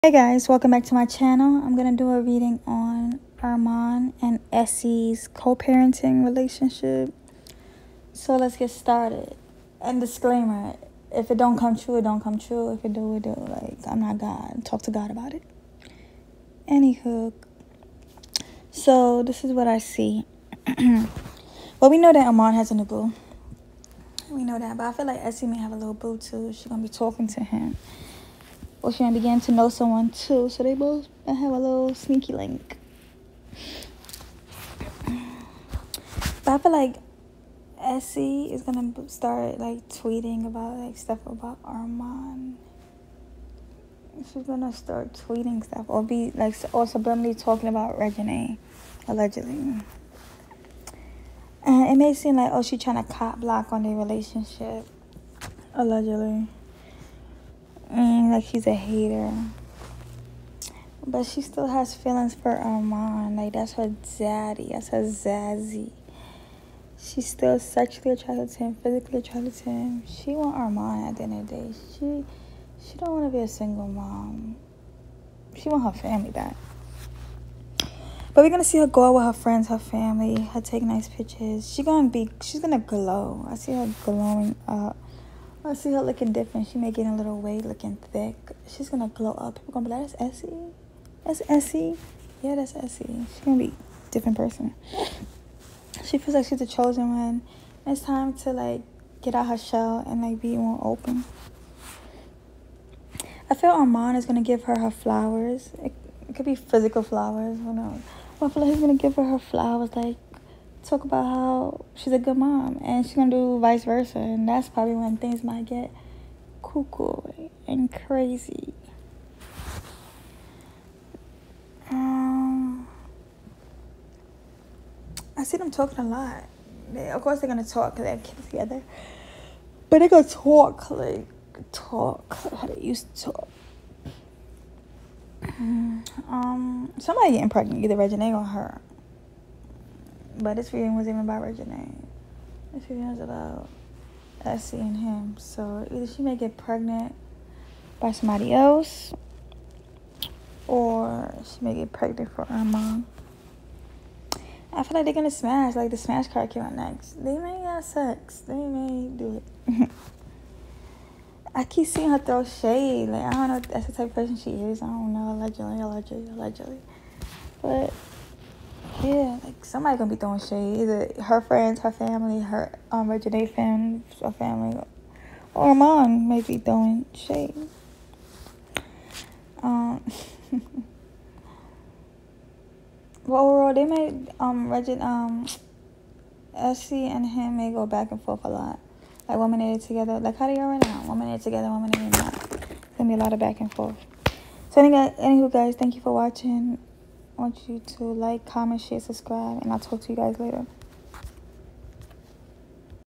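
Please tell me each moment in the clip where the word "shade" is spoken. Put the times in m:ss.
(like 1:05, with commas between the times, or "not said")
2:42, 2:50, 2:57.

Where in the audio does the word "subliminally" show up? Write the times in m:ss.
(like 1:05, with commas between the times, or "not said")
0:46.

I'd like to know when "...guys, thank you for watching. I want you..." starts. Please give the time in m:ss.
3:15.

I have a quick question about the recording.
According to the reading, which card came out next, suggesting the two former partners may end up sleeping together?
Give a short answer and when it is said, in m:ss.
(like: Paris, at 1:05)
smash card, at 2:35.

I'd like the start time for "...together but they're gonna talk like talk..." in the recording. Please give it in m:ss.
2:08.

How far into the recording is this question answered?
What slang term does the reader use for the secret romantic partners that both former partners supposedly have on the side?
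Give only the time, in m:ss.
0:31.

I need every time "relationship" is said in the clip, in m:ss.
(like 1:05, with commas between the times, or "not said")
0:06, 0:53.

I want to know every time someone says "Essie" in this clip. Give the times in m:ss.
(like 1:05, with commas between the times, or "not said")
0:04, 0:25.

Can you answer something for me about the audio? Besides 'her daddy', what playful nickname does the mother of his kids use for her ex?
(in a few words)
Zazzy.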